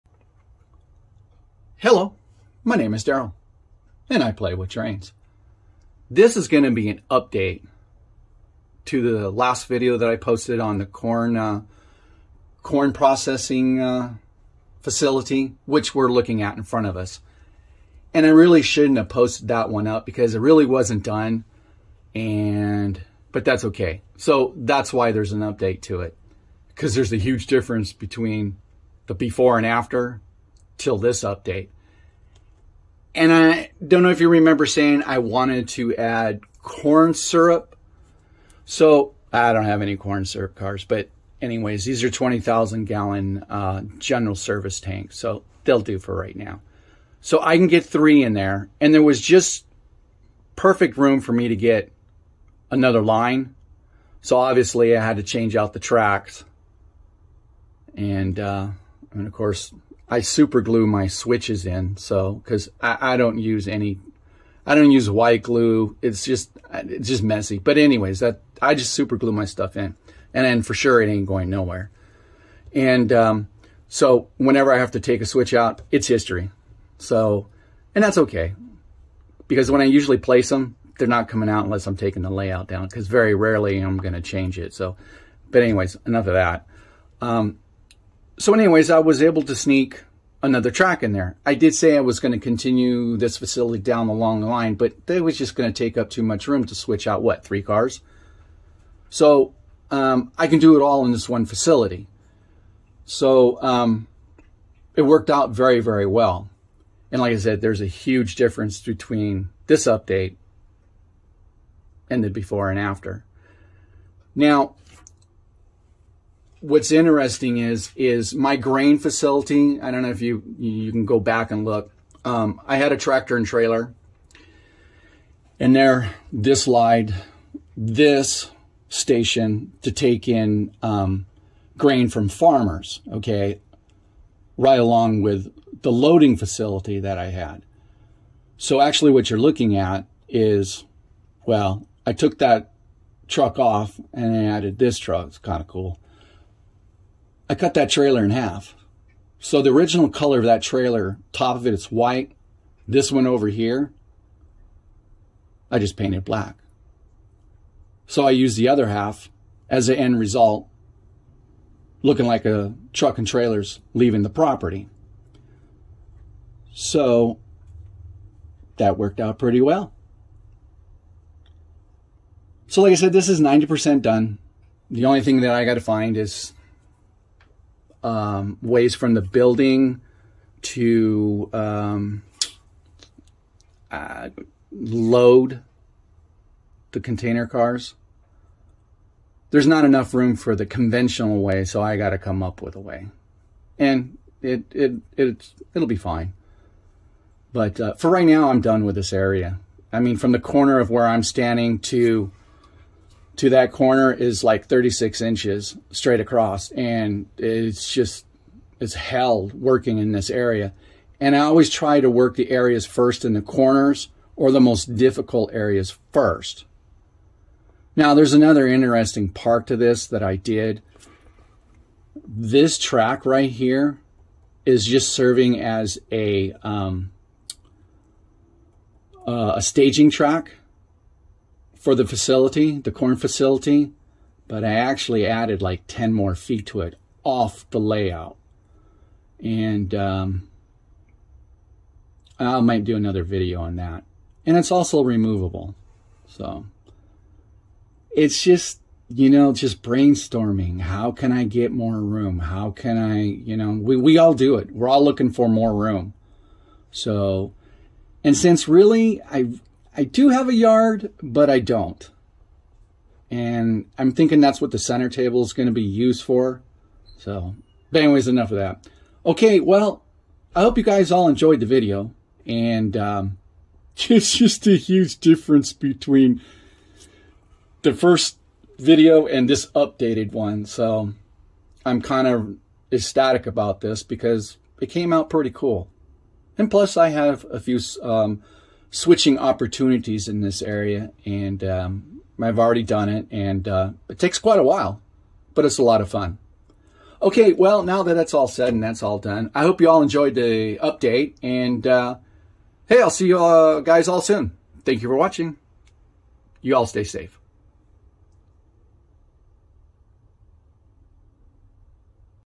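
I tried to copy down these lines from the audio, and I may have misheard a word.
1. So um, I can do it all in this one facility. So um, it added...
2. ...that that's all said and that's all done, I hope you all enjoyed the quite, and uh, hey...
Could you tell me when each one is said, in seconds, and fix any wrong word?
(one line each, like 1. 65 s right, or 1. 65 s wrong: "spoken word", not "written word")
1. 99 s wrong: "worked", not "added"
2. 298 s wrong: "update", not "quite".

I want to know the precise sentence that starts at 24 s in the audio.
So that's why there's an update to it because there's a huge difference between the before and after till this update.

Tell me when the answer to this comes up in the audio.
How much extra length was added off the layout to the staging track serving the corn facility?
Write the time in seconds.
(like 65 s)
235 s.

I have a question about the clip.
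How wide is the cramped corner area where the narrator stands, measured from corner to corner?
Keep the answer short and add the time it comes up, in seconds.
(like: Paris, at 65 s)
36 inches, at 204 s.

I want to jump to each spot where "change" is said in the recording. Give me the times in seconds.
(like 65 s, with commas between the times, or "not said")
55 s, 84 s.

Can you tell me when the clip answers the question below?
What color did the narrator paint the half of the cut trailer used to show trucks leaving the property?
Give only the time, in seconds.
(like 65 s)
156 s.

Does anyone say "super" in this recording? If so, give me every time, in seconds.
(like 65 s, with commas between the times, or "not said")
60 s, 68 s.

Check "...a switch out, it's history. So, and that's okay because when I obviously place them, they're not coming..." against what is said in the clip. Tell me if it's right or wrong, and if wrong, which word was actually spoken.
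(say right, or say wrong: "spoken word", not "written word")
wrong: "usually", not "obviously".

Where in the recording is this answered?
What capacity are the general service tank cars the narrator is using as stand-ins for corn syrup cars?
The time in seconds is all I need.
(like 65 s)
42 s.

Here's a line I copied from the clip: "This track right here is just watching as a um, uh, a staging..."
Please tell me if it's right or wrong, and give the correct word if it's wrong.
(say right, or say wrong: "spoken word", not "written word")
wrong: "serving", not "watching".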